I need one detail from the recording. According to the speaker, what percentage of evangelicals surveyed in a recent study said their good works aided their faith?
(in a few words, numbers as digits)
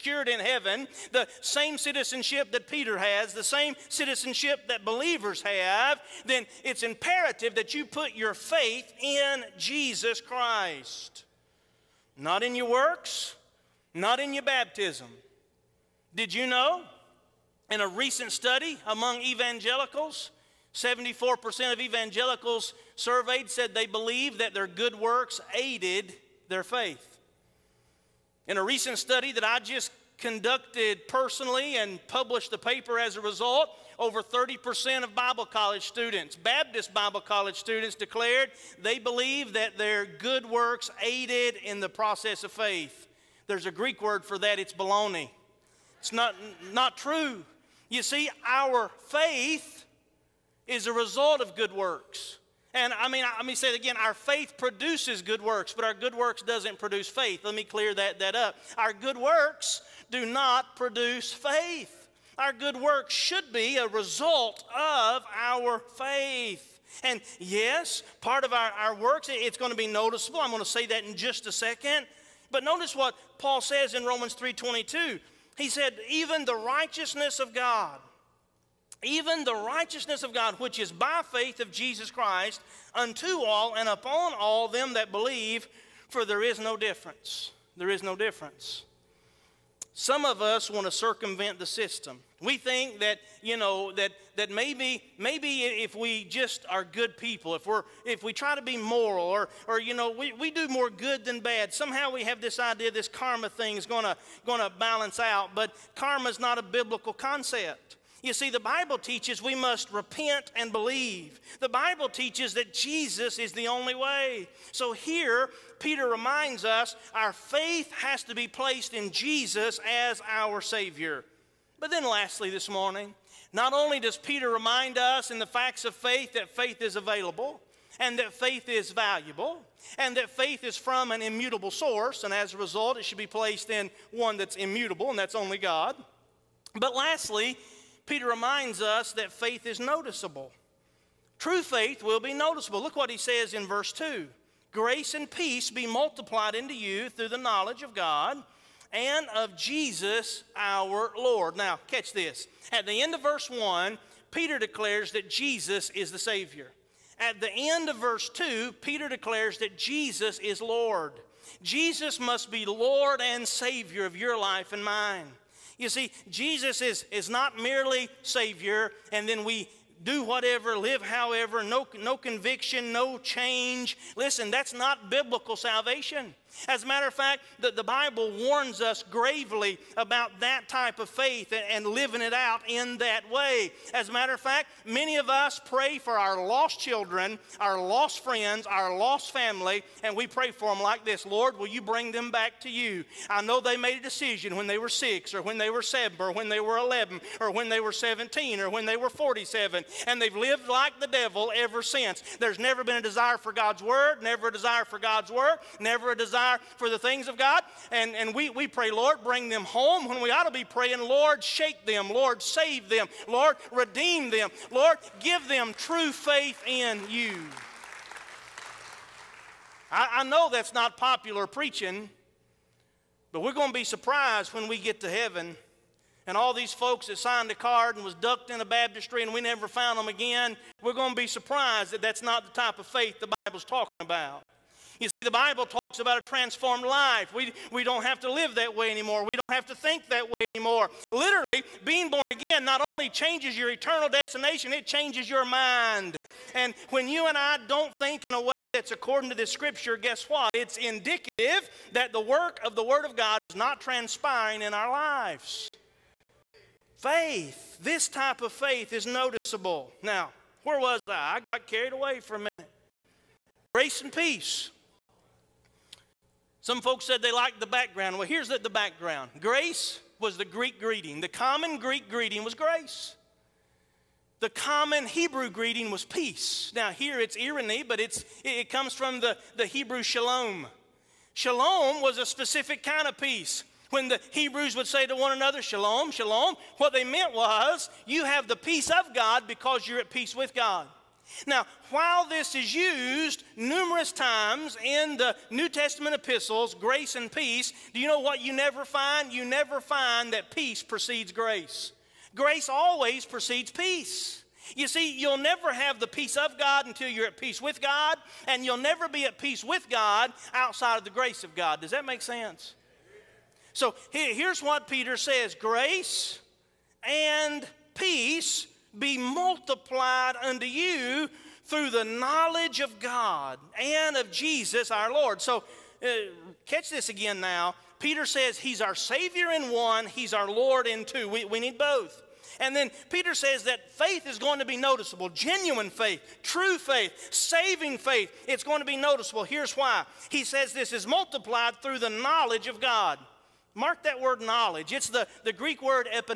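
74%.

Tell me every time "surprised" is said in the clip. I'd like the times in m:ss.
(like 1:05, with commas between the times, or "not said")
3:43, 3:51.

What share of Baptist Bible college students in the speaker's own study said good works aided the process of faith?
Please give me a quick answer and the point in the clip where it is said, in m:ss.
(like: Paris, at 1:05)
Over 30%, at 0:33.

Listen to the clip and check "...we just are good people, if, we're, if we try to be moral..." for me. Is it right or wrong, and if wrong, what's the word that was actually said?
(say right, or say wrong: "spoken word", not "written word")
right.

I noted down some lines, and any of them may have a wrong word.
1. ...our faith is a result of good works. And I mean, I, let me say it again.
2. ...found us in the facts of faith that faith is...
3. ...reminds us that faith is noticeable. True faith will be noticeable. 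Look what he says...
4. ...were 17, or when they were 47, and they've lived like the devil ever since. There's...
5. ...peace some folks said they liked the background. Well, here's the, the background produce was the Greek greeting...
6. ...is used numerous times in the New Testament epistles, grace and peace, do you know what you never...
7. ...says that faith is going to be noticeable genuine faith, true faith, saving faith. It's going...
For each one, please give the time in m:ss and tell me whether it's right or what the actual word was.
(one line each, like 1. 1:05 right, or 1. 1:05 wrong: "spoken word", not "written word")
1. 0:48 right
2. 2:04 wrong: "remind", not "found"
3. 2:18 right
4. 3:17 right
5. 4:24 wrong: "grace", not "produce"
6. 4:52 right
7. 5:33 right.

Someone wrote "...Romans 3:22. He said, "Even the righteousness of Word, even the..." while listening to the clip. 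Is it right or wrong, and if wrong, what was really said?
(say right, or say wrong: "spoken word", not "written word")
wrong: "God", not "Word".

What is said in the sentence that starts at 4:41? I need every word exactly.
Shalom was a specific kind of peace.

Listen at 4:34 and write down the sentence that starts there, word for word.
The common Hebrew greeting was peace.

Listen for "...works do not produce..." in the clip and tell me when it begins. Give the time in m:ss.
0:59.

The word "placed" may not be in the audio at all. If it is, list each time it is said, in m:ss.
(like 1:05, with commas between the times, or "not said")
1:58, 2:13.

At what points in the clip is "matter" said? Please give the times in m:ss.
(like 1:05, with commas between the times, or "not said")
2:56, 3:04.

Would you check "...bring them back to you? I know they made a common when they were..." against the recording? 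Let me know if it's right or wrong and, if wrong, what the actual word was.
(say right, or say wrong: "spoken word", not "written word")
wrong: "decision", not "common".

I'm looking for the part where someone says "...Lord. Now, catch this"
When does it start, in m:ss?
2:31.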